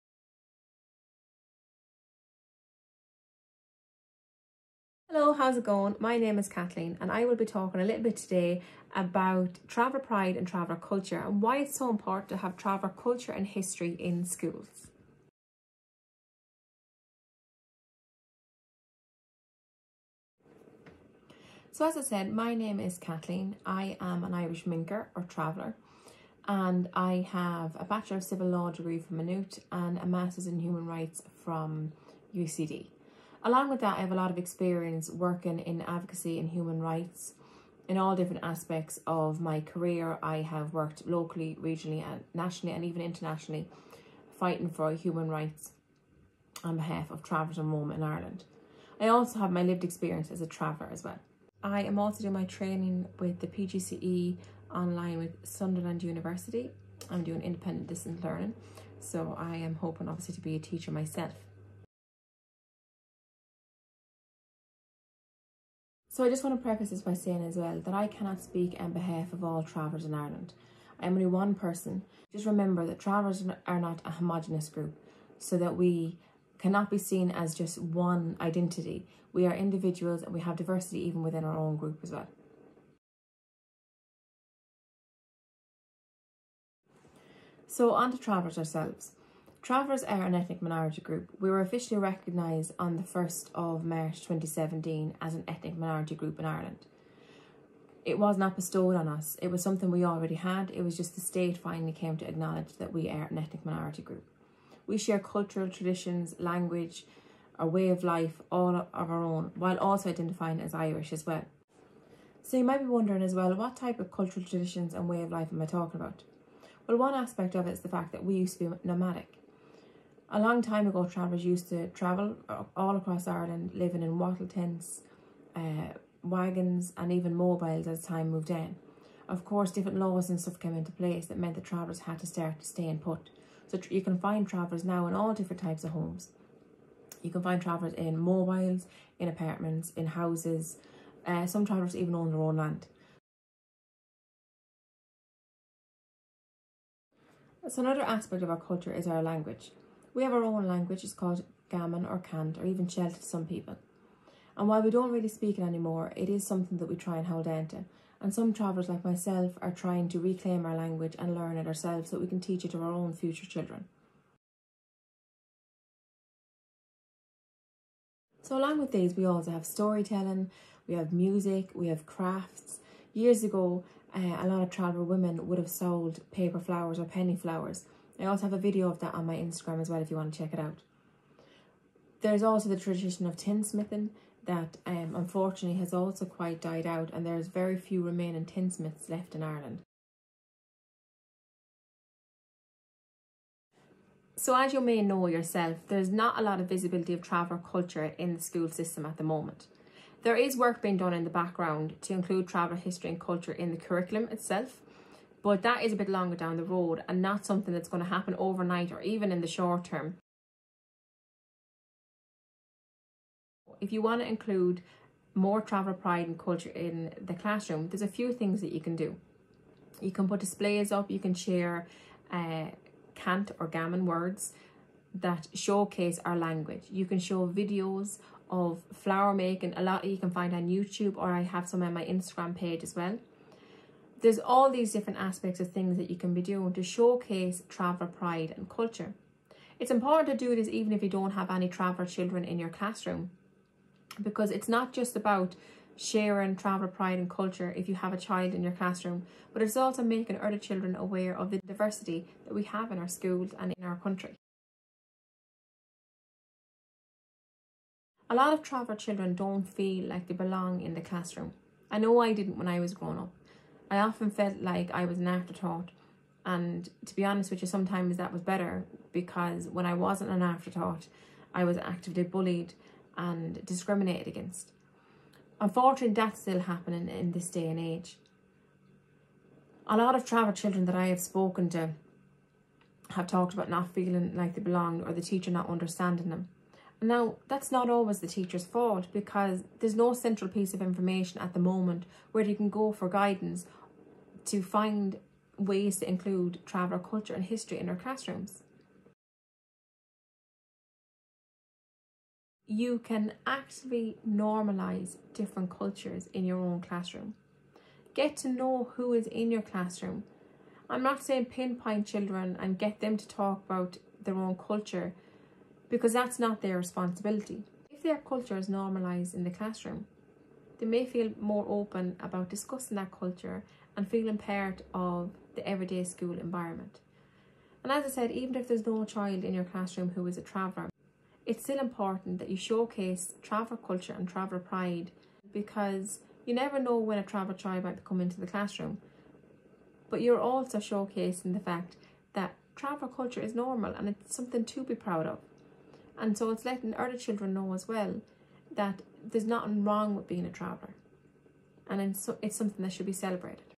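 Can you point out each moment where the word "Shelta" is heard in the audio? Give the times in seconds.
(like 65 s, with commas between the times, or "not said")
152 s.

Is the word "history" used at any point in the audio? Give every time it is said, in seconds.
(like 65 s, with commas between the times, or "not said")
13 s, 202 s, 297 s.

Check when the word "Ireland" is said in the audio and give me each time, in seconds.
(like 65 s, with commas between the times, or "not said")
48 s, 70 s, 96 s, 123 s, 189 s.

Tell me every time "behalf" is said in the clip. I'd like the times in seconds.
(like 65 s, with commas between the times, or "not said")
46 s, 68 s.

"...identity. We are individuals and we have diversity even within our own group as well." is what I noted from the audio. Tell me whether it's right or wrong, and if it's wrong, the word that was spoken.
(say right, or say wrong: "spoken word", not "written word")
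right.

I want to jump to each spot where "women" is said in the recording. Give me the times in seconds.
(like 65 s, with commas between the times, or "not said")
175 s.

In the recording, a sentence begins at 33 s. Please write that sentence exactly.
Along with that, I have a lot of experience working in advocacy and human rights in all different aspects of my career.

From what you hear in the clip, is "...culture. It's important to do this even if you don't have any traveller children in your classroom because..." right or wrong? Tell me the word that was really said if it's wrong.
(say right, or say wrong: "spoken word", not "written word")
right.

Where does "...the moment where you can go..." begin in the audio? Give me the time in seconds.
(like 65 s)
291 s.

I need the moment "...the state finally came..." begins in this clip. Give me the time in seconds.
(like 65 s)
101 s.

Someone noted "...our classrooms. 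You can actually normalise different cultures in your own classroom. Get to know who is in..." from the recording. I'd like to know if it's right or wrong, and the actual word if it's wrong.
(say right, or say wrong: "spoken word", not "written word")
right.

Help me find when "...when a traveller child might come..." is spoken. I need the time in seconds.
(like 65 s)
336 s.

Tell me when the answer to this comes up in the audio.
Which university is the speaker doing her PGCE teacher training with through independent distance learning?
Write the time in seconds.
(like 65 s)
55 s.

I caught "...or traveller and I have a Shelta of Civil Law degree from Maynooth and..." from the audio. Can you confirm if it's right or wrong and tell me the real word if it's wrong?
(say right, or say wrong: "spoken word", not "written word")
wrong: "Bachelor", not "Shelta".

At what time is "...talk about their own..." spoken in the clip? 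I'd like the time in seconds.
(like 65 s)
313 s.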